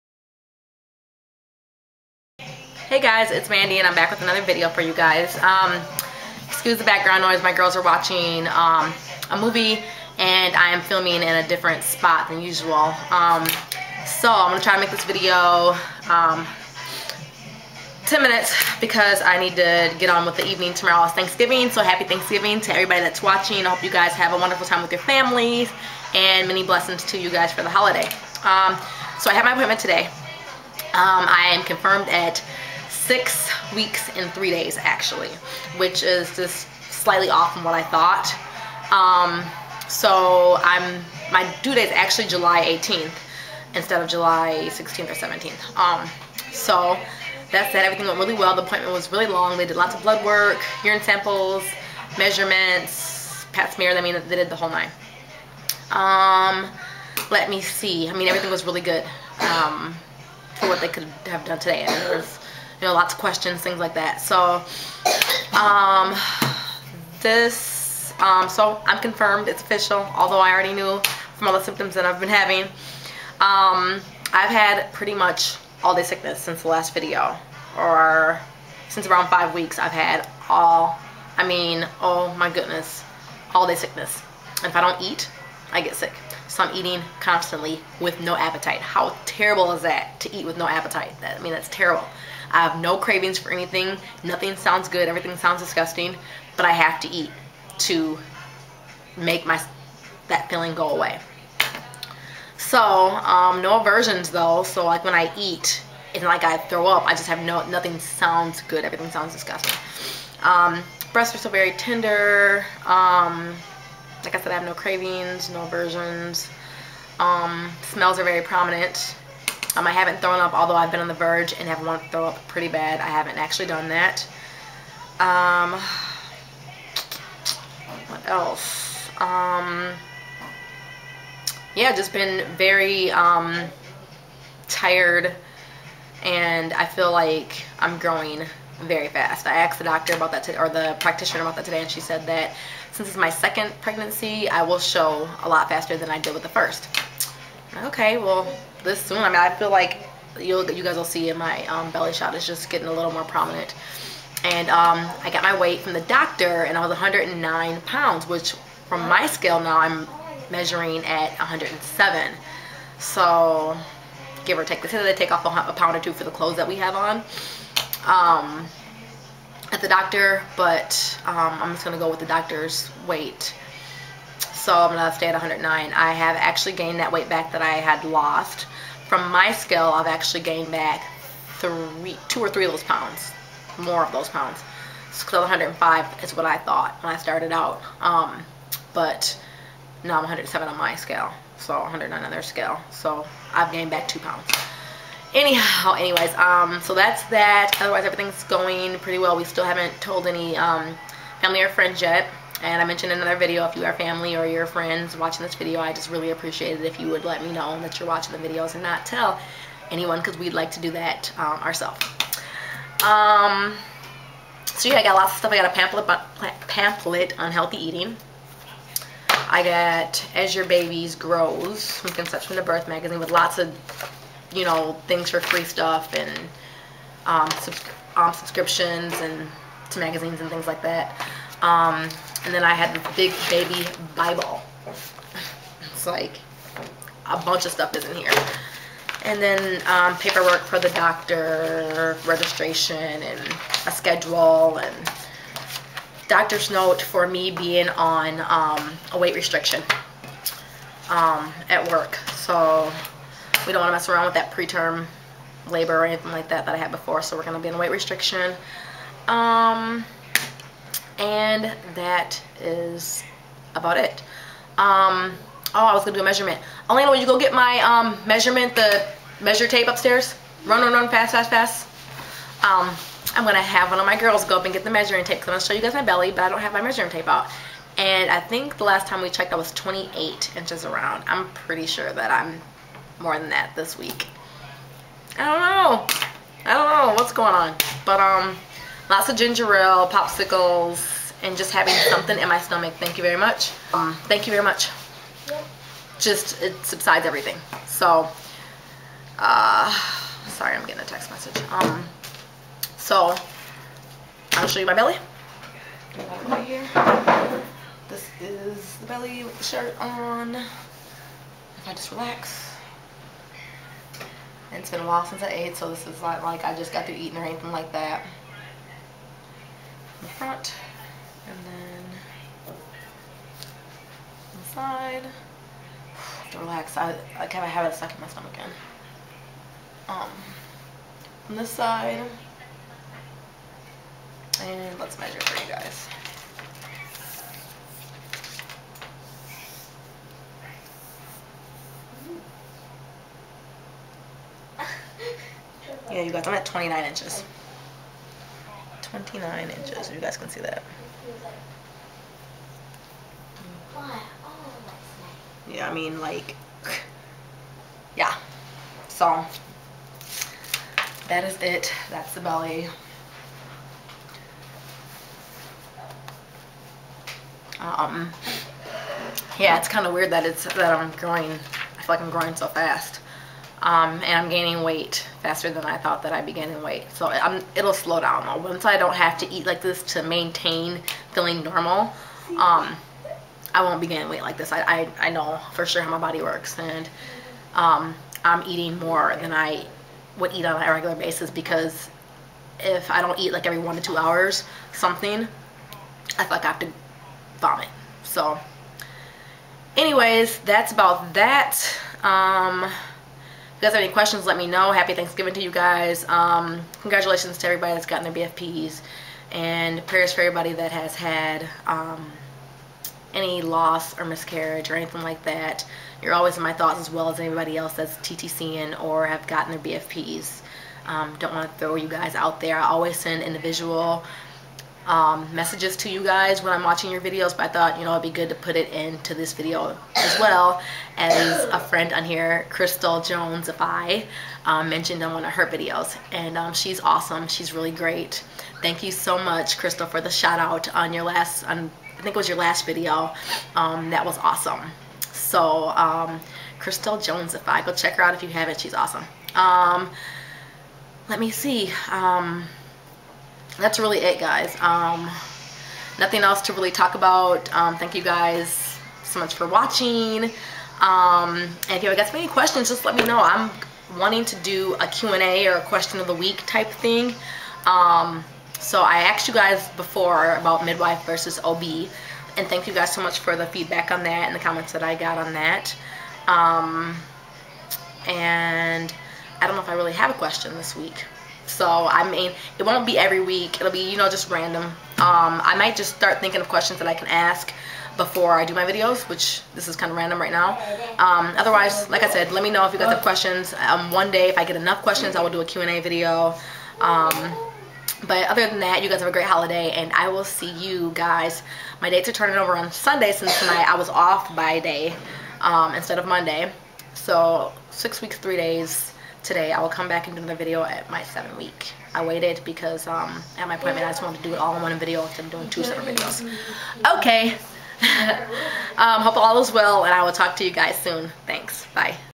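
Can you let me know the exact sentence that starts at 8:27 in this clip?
So six weeks, three days, today.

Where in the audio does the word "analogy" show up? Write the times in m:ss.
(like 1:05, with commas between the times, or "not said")
not said.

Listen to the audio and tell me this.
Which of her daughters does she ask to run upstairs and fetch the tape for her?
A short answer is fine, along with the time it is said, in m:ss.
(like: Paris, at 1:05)
Alaina, at 4:26.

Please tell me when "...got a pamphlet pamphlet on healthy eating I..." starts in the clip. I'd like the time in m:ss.
3:35.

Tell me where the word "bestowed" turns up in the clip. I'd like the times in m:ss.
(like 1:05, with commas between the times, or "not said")
not said.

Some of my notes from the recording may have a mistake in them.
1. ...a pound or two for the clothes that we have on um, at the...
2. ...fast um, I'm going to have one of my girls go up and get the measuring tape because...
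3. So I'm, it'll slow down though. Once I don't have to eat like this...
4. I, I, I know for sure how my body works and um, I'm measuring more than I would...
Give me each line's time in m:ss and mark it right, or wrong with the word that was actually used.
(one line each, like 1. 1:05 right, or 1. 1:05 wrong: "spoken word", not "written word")
1. 2:45 right
2. 4:31 right
3. 6:17 right
4. 6:24 wrong: "eating", not "measuring".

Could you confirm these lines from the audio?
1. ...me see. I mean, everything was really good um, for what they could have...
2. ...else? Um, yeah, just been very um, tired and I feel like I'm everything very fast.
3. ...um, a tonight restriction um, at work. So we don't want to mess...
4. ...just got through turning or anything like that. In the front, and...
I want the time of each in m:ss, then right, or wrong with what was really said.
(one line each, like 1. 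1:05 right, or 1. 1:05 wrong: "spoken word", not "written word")
1. 0:57 right
2. 2:08 wrong: "growing", not "everything"
3. 4:08 wrong: "weight", not "tonight"
4. 5:16 wrong: "eating", not "turning".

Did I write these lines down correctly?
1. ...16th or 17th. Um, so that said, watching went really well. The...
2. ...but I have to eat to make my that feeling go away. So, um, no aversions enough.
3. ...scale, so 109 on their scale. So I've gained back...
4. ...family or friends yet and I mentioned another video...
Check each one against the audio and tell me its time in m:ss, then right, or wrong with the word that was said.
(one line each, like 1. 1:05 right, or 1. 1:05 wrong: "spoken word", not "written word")
1. 0:44 wrong: "everything", not "watching"
2. 1:36 wrong: "though", not "enough"
3. 3:10 right
4. 3:21 right.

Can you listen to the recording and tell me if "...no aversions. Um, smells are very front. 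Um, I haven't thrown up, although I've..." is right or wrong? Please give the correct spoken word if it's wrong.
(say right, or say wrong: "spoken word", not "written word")
wrong: "prominent", not "front".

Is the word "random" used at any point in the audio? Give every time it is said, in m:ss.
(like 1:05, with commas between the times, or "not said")
8:04, 8:10.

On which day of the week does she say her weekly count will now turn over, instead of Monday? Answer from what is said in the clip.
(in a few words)
Sunday.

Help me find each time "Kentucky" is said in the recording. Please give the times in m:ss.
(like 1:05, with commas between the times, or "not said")
not said.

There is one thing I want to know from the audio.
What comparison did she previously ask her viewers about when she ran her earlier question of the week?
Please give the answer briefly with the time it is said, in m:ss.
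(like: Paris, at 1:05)
Midwife versus OB, at 7:50.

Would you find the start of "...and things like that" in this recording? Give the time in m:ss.
3:50.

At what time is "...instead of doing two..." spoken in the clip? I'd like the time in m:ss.
8:35.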